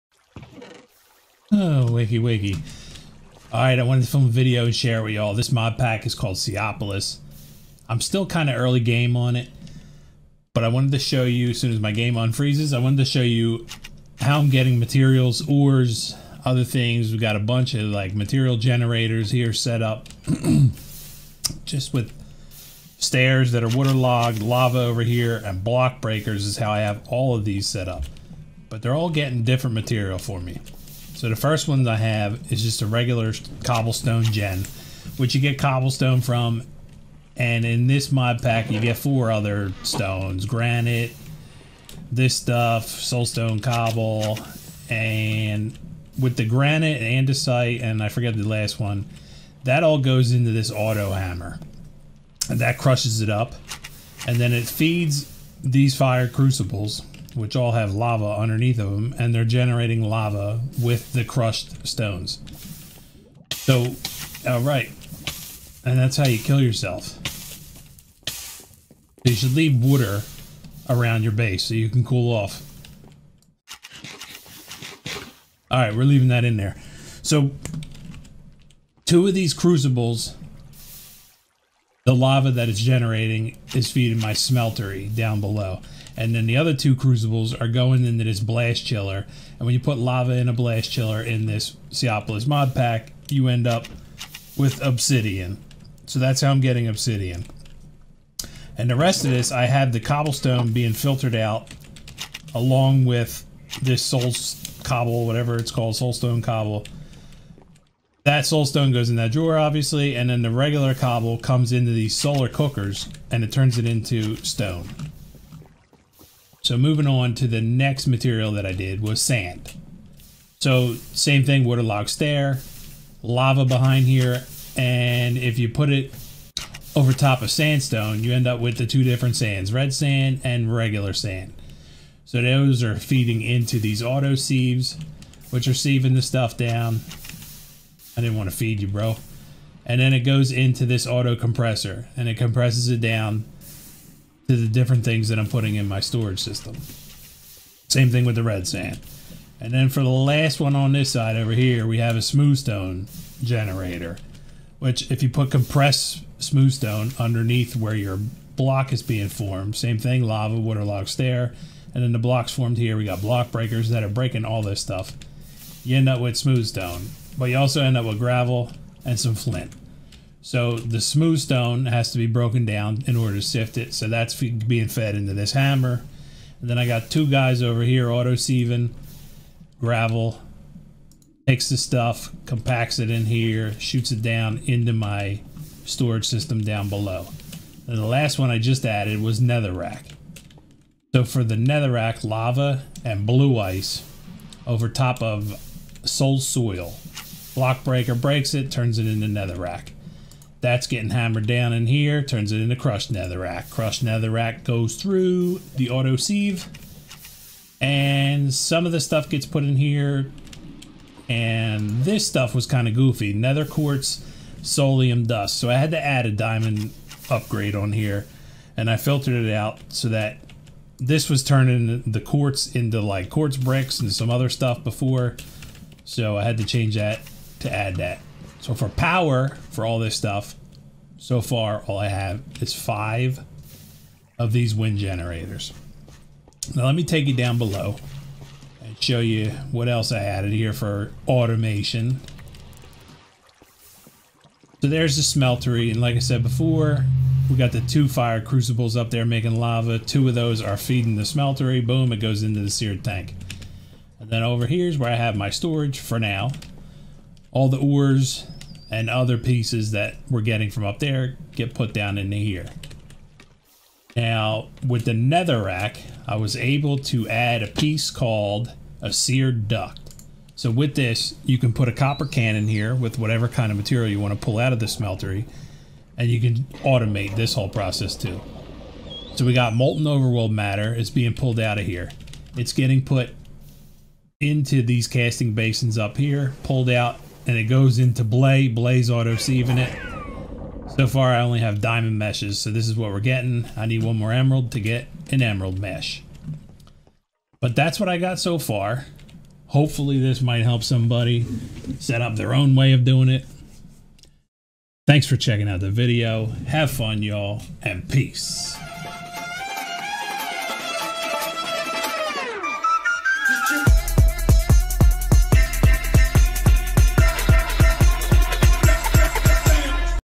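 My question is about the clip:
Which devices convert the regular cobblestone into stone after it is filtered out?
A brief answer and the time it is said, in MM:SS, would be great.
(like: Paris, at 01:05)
Solar cookers, at 01:52.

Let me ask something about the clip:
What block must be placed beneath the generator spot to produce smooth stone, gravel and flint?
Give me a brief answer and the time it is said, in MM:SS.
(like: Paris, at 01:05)
Compressed smooth stone, at 02:35.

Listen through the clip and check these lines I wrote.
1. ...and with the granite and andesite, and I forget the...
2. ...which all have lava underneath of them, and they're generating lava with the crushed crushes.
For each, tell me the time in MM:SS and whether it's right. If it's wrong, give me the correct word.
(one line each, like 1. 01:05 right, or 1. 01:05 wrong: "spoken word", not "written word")
1. 00:44 right
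2. 00:57 wrong: "stones", not "crushes".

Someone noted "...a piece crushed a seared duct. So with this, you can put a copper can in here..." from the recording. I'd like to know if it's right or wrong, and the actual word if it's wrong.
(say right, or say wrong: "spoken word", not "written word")
wrong: "called", not "crushed".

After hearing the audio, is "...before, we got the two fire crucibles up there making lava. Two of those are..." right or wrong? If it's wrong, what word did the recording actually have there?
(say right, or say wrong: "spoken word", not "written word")
right.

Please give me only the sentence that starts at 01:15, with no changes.
All right, we're leaving that in there.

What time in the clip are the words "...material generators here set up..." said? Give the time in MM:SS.
00:18.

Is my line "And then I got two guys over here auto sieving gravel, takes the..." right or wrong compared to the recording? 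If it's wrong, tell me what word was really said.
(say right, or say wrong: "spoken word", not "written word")
right.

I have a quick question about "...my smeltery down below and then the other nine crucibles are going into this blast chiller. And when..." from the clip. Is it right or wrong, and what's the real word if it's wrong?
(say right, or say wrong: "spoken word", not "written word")
wrong: "two", not "nine".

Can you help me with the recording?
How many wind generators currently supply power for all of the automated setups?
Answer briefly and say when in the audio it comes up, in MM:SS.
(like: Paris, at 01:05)
5, at 03:52.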